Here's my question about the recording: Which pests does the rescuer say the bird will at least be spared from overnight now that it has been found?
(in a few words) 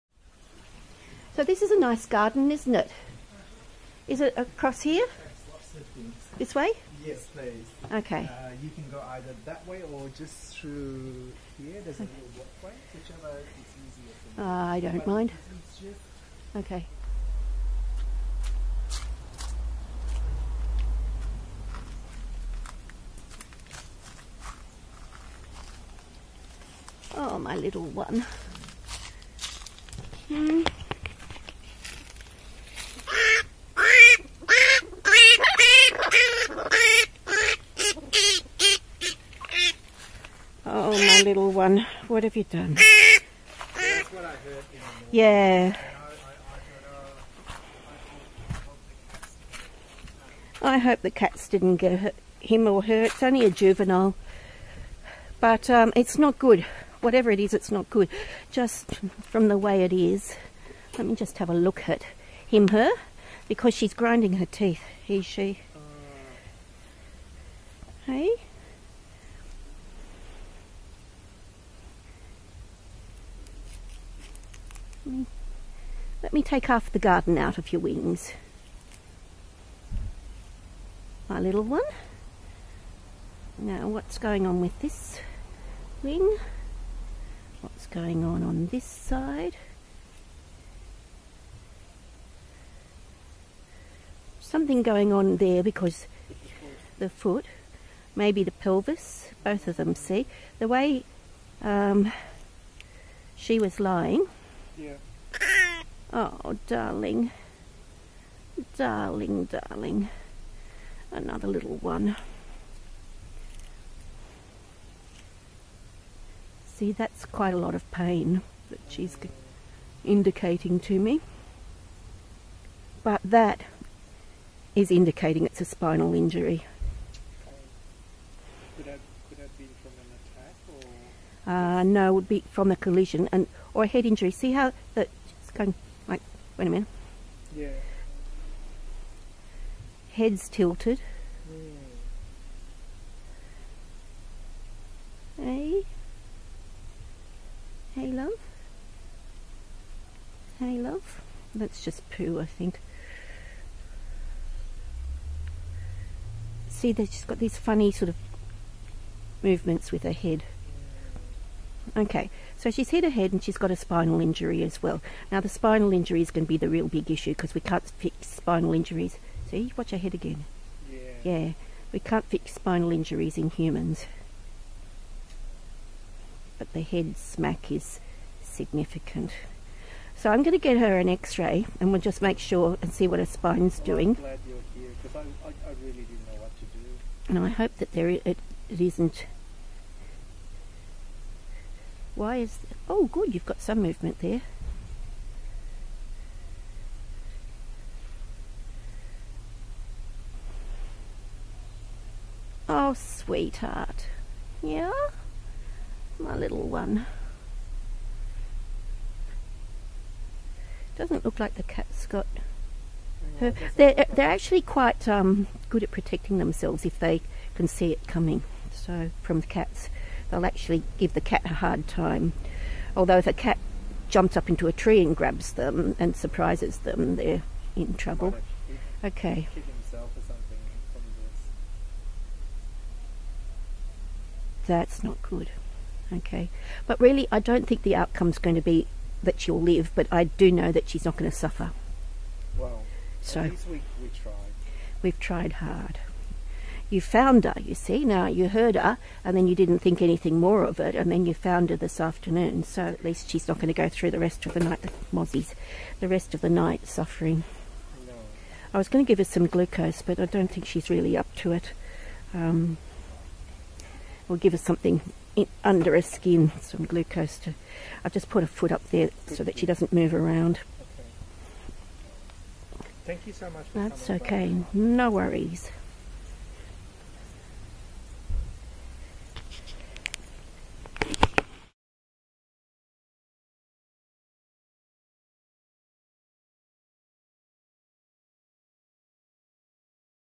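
Mozzies.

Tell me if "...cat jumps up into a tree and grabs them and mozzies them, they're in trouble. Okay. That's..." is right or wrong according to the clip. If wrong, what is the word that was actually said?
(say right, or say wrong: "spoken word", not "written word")
wrong: "surprises", not "mozzies".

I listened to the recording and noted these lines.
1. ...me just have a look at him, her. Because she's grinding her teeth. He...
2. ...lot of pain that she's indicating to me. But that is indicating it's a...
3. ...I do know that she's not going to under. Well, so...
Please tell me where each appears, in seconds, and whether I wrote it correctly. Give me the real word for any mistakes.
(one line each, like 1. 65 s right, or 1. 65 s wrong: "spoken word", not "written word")
1. 61 s right
2. 117 s right
3. 240 s wrong: "suffer", not "under".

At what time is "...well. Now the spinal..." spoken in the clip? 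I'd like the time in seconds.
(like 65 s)
164 s.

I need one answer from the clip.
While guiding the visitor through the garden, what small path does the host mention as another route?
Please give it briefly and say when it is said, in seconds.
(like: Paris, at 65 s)
Walkway, at 12 s.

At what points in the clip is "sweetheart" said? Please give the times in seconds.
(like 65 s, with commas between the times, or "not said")
202 s.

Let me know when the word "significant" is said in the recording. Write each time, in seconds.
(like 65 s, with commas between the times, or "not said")
178 s.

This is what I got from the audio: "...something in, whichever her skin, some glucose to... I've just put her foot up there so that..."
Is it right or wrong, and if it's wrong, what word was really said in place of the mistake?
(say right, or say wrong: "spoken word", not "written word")
wrong: "under", not "whichever".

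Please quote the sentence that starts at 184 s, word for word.
I'm glad you're here because I, I, I, really didn't know what to do.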